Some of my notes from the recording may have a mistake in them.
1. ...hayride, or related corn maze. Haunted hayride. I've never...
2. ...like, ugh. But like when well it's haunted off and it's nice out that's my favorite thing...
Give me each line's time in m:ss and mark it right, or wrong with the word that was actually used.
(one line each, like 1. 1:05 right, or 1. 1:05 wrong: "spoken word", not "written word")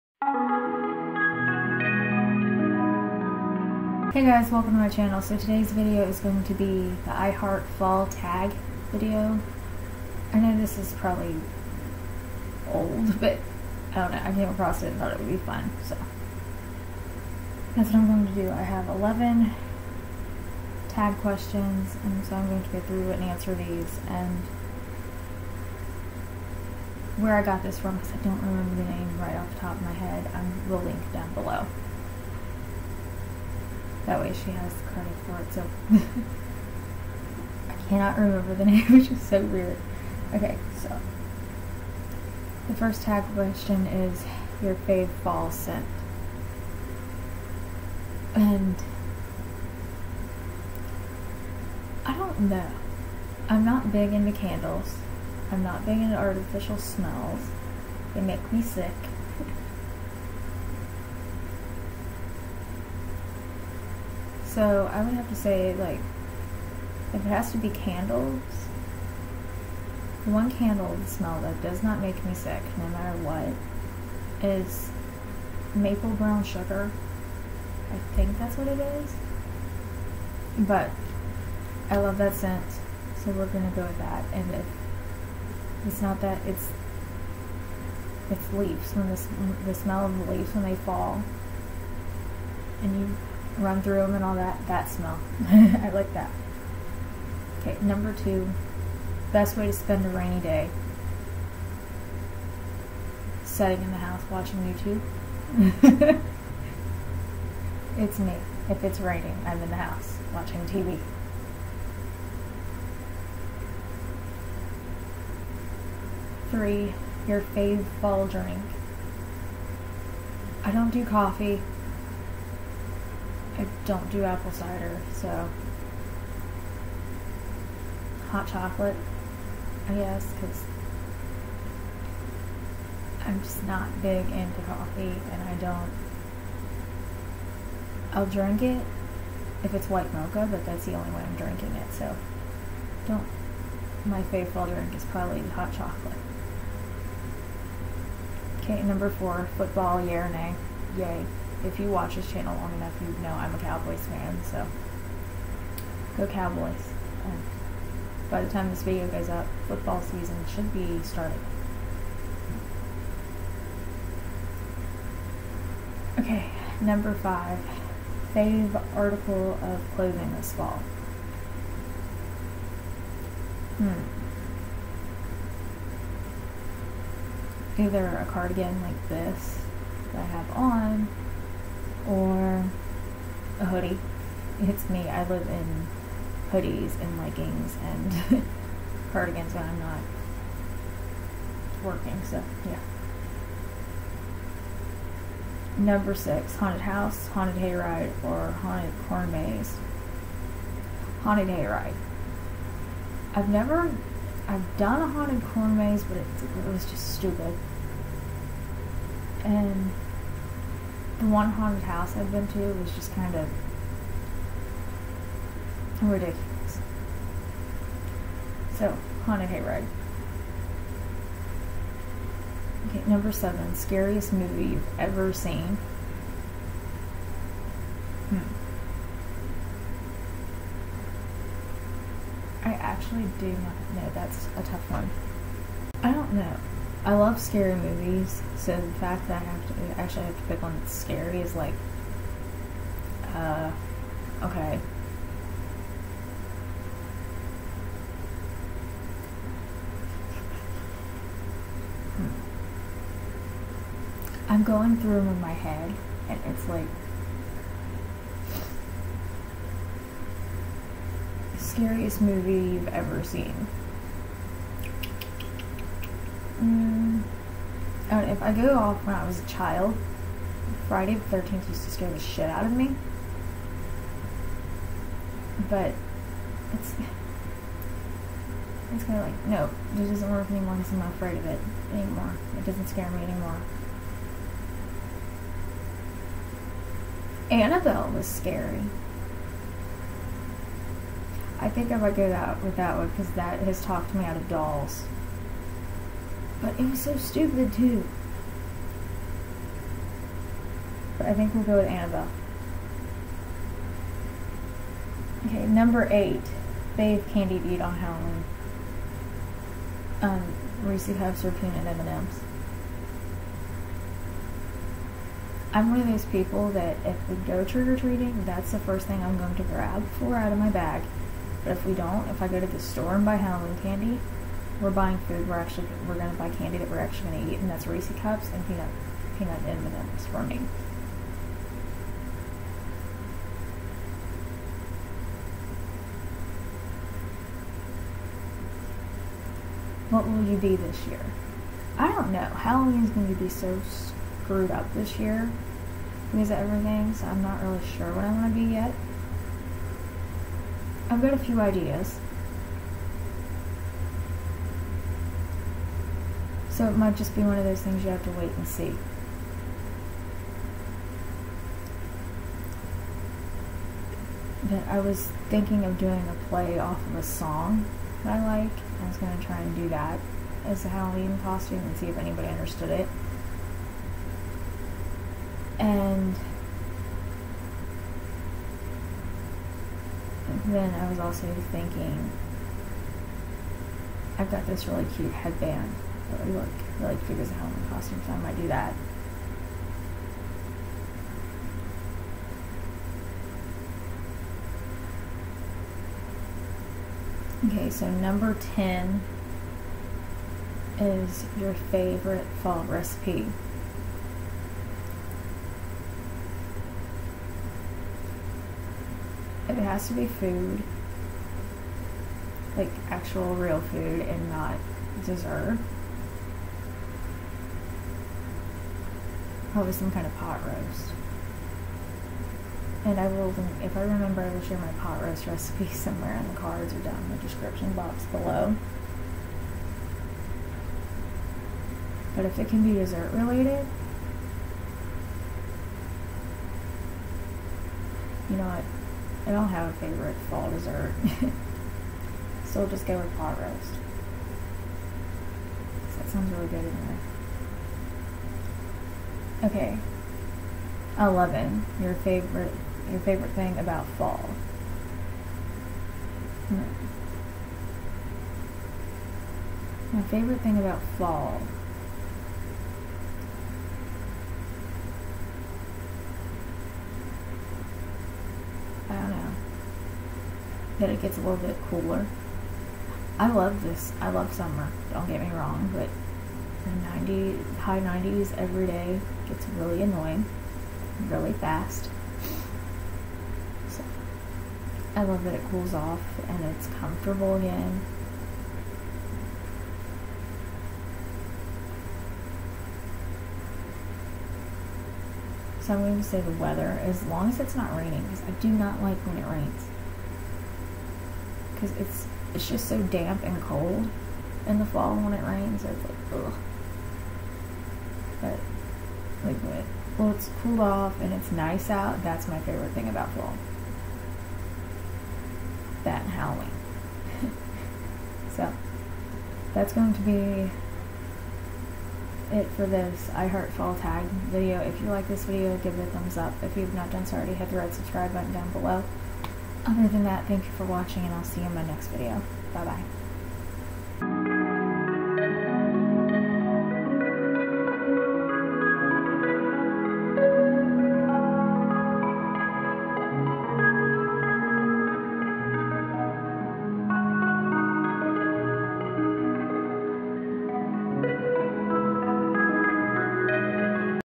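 1. 3:17 wrong: "haunted", not "related"
2. 8:26 wrong: "cooled", not "haunted".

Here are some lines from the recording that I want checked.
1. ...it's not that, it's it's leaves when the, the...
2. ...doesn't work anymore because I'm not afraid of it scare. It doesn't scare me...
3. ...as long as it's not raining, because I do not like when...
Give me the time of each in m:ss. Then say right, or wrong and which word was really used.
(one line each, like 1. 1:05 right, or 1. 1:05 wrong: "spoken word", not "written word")
1. 1:25 right
2. 4:40 wrong: "anymore", not "scare"
3. 8:17 right.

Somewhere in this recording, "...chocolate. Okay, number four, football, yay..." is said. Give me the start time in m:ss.
2:25.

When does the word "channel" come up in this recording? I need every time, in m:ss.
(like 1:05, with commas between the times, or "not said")
0:04, 2:32.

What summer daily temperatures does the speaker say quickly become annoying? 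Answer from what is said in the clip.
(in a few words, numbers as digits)
High 90s.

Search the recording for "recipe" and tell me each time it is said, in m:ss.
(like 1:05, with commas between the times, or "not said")
6:42, 7:05.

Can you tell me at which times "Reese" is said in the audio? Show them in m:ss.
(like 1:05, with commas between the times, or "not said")
5:10, 5:27.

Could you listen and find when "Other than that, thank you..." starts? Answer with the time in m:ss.
8:49.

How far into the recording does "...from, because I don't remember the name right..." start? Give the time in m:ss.
0:27.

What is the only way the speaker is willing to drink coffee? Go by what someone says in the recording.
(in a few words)
White mocha.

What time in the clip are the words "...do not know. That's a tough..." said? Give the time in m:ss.
3:53.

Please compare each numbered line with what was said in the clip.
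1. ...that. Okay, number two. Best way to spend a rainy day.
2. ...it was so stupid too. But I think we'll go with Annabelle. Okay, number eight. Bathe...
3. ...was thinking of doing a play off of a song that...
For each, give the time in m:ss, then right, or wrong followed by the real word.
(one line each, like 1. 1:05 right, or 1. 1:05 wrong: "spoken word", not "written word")
1. 1:36 right
2. 4:56 right
3. 6:05 right.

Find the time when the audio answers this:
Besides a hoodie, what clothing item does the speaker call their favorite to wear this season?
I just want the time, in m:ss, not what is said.
2:58.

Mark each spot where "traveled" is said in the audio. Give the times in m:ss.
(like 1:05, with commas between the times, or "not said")
not said.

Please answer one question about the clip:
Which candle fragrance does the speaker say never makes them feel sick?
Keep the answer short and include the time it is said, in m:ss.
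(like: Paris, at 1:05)
Maple brown sugar, at 1:15.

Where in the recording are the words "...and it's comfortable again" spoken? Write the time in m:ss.
8:06.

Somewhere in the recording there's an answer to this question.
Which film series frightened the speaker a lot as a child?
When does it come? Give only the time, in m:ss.
4:30.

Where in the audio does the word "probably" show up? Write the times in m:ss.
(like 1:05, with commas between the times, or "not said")
0:10, 2:25, 6:59.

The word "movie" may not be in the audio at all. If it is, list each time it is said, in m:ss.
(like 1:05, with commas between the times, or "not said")
3:44, 3:57, 4:22.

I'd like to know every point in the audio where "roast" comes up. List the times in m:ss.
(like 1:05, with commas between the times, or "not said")
7:00, 7:05, 7:23.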